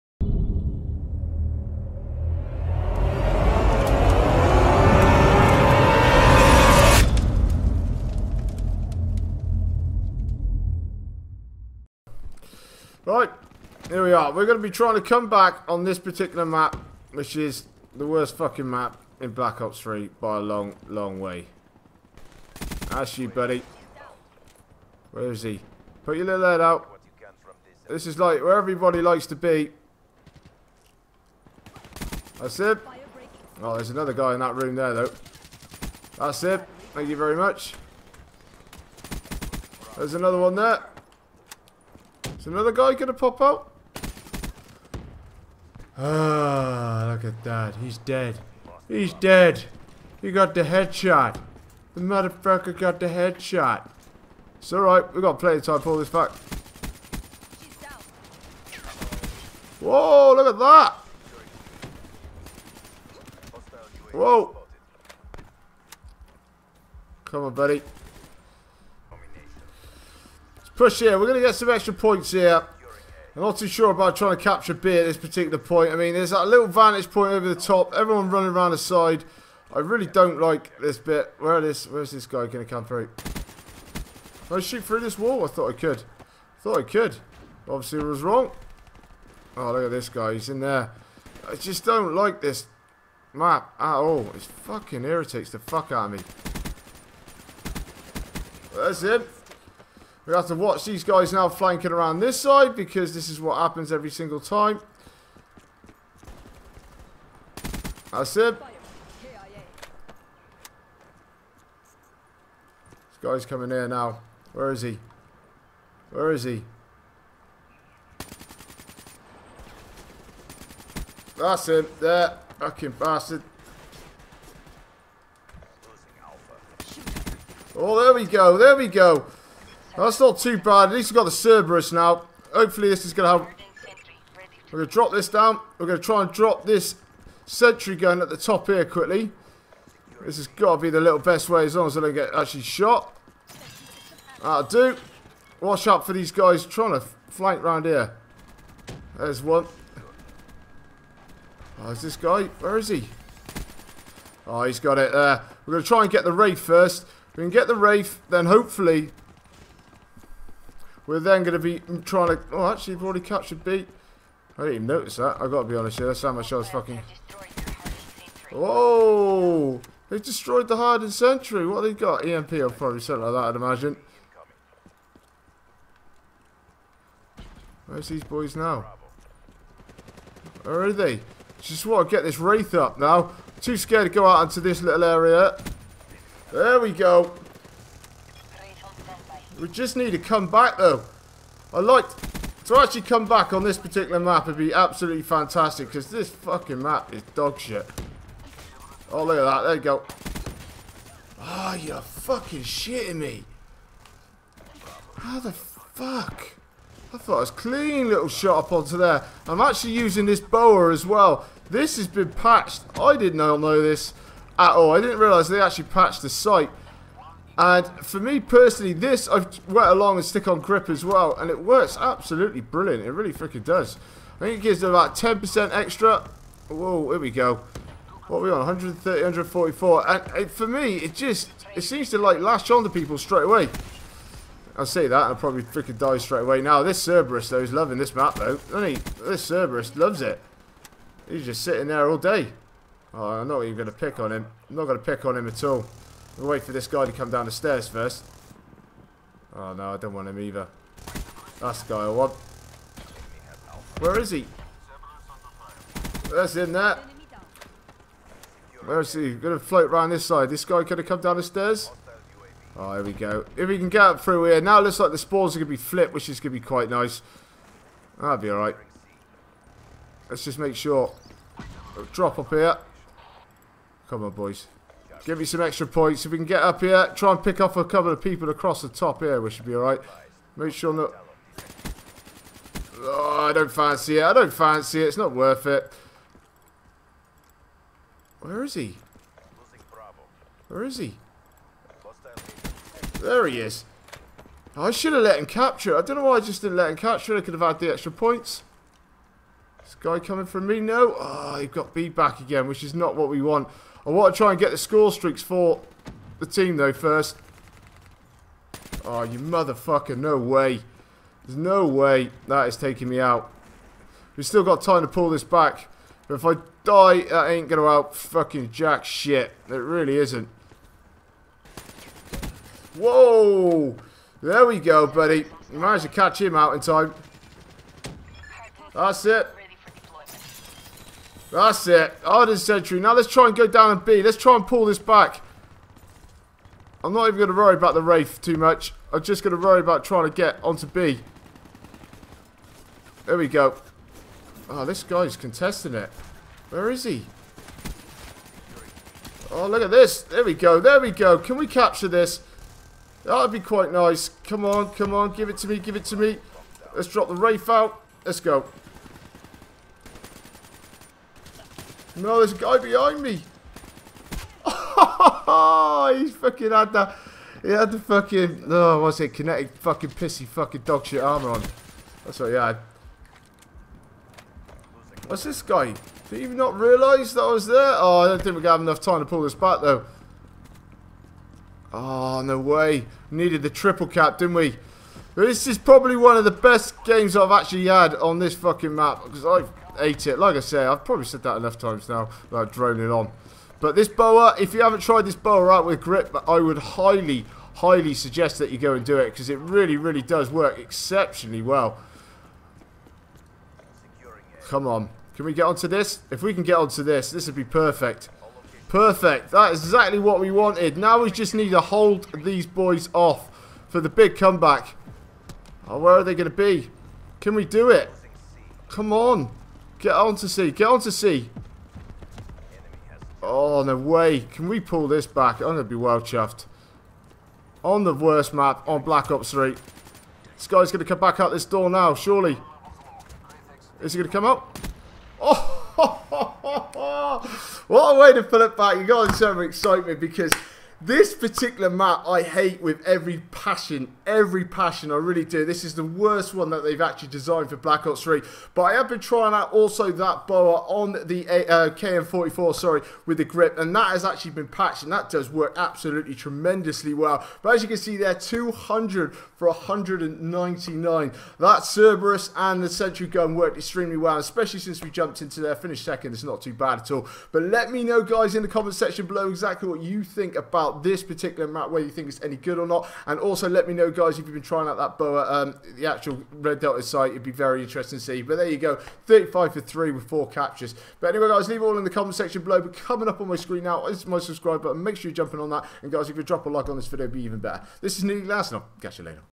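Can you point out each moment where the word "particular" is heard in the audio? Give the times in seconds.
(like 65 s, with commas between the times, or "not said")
15 s, 75 s, 193 s, 441 s, 471 s.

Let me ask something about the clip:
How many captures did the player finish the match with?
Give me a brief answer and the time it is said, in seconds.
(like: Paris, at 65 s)
4, at 480 s.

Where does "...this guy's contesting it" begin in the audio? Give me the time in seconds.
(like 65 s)
344 s.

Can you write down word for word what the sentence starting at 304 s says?
I want to try and get the score streaks for the team, though, first.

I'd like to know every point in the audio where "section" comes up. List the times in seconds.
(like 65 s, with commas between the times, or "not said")
468 s, 482 s.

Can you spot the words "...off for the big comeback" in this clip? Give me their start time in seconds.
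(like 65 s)
413 s.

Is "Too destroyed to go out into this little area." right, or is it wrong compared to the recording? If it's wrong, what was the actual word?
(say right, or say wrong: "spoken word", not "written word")
wrong: "scared", not "destroyed".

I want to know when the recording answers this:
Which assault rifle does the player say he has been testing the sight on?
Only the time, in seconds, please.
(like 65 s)
451 s.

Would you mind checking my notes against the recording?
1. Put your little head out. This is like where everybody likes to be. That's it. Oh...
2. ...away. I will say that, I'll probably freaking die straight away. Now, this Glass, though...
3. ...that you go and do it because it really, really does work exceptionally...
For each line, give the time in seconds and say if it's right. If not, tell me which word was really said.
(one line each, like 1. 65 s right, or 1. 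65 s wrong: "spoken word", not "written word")
1. 26 s right
2. 233 s wrong: "Cerberus", not "Glass"
3. 398 s right.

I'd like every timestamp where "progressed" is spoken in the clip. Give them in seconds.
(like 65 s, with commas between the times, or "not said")
not said.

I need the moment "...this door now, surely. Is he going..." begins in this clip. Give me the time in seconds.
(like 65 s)
431 s.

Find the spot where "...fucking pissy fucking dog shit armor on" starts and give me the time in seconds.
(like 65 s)
369 s.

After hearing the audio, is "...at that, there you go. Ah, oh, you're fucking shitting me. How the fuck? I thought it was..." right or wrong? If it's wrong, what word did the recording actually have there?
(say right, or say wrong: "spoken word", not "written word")
right.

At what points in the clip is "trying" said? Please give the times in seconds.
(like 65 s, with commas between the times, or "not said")
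14 s, 74 s, 146 s, 162 s, 340 s, 449 s, 474 s.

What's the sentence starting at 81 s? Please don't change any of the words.
Where is where's this guy going to come through?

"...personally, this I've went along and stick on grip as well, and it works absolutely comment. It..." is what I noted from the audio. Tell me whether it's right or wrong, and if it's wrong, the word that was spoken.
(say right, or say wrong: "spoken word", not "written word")
wrong: "brilliant", not "comment".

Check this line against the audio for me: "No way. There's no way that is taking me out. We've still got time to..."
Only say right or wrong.
right.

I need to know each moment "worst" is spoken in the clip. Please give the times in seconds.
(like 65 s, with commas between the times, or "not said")
18 s, 428 s, 446 s.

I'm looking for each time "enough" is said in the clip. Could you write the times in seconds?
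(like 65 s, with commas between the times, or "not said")
378 s, 391 s.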